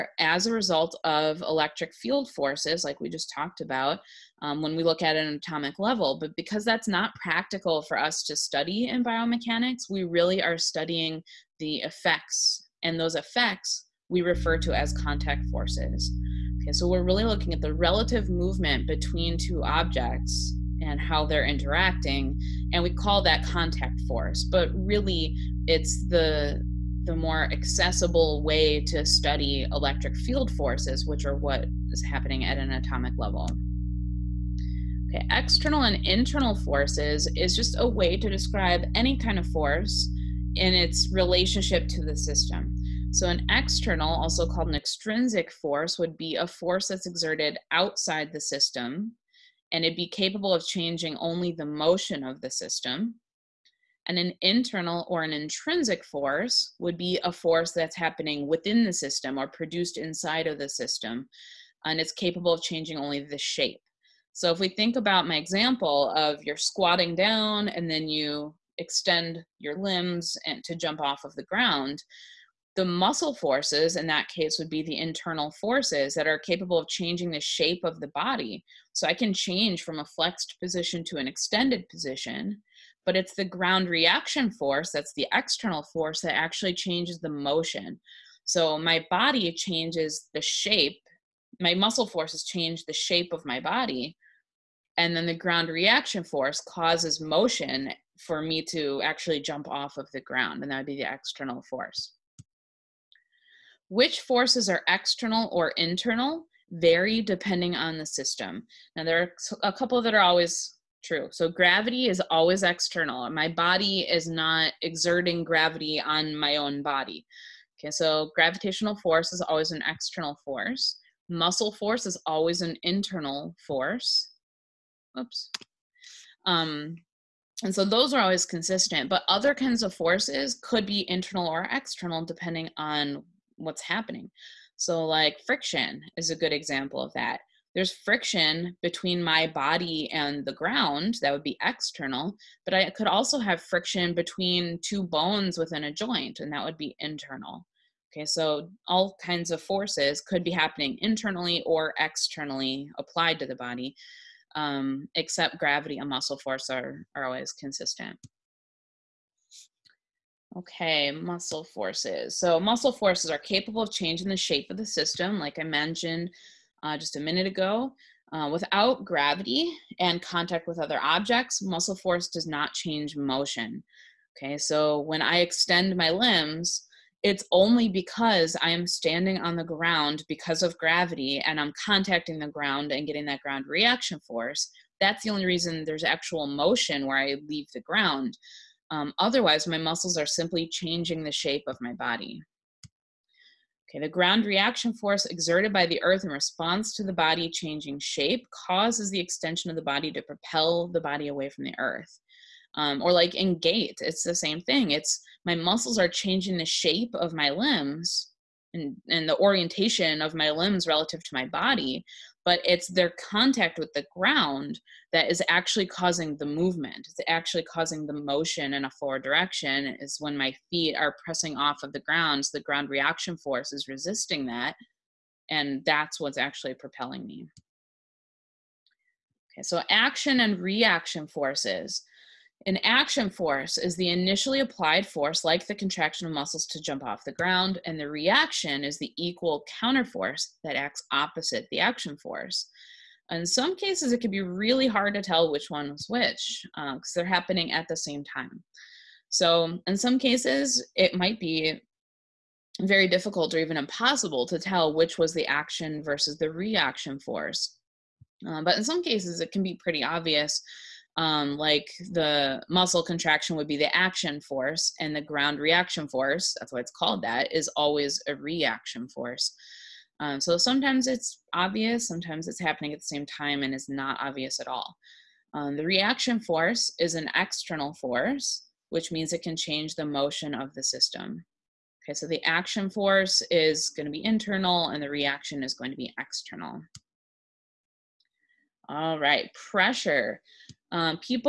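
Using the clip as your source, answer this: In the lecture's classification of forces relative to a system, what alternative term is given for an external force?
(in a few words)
Extrinsic force.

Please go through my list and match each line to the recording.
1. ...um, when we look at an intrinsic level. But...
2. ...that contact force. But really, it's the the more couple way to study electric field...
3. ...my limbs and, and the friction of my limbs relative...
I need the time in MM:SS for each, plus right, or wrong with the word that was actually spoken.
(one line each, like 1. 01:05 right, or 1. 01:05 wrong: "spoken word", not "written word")
1. 00:04 wrong: "atomic", not "intrinsic"
2. 00:23 wrong: "accessible", not "couple"
3. 03:27 wrong: "orientation", not "friction".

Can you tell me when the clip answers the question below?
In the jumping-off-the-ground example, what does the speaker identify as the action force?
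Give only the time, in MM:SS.
04:22.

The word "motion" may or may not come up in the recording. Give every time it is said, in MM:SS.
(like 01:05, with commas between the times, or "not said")
00:51, 01:27, 01:37, 02:53, 03:06, 03:38, 04:40.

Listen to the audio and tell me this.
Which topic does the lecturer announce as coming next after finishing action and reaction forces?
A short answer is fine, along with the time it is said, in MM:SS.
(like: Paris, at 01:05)
Pressure, at 04:49.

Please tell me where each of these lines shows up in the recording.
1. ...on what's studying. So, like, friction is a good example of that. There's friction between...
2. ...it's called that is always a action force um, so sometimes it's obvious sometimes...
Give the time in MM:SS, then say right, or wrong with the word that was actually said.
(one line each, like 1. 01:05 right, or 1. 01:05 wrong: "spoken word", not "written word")
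1. 02:12 wrong: "happening", not "studying"
2. 04:26 wrong: "reaction", not "action".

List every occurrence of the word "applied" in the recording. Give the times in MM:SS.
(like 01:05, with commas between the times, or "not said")
02:32, 03:54.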